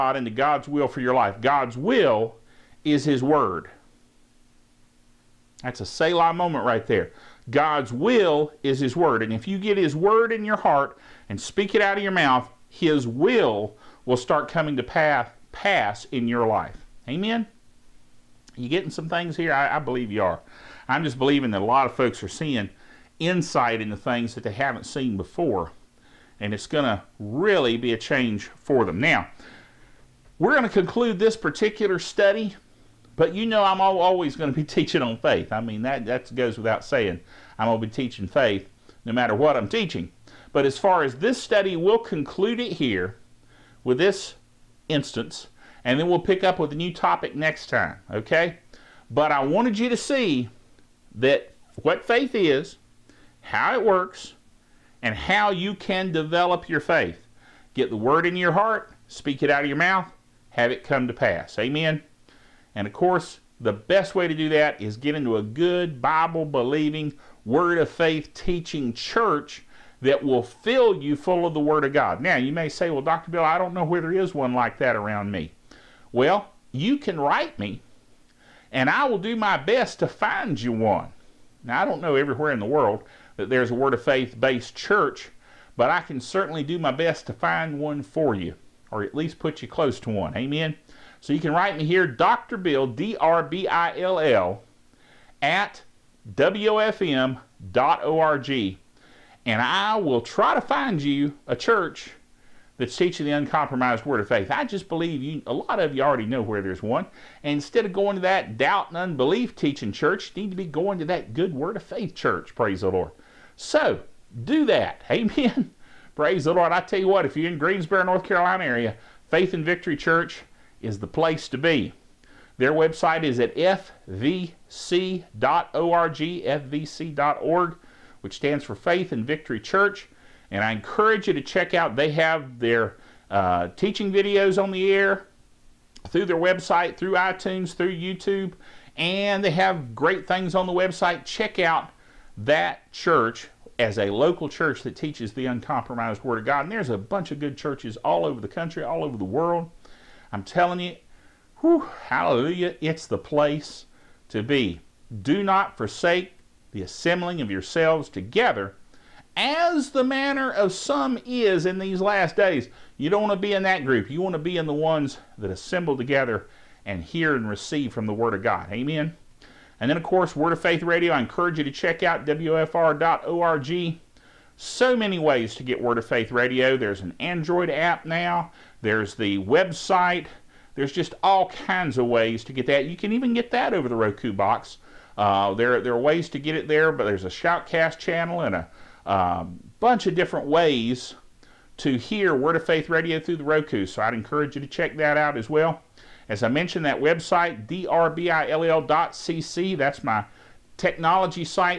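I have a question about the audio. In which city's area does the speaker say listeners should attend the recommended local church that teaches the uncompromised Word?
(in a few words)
Greensboro, North Carolina.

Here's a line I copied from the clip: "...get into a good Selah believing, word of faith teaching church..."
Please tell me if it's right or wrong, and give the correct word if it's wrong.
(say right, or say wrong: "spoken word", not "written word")
wrong: "Bible", not "Selah".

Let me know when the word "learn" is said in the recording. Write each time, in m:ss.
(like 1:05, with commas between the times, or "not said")
not said.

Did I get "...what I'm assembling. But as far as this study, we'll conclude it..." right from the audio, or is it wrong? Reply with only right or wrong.
wrong.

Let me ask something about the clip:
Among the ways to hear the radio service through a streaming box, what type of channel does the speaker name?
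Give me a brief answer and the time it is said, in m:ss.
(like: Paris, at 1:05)
Shoutcast, at 3:07.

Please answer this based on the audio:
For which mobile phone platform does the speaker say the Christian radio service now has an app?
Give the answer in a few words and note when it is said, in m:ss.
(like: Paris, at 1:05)
Android, at 2:57.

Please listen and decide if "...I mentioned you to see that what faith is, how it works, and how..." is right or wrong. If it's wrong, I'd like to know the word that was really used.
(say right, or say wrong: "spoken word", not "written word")
wrong: "wanted", not "mentioned".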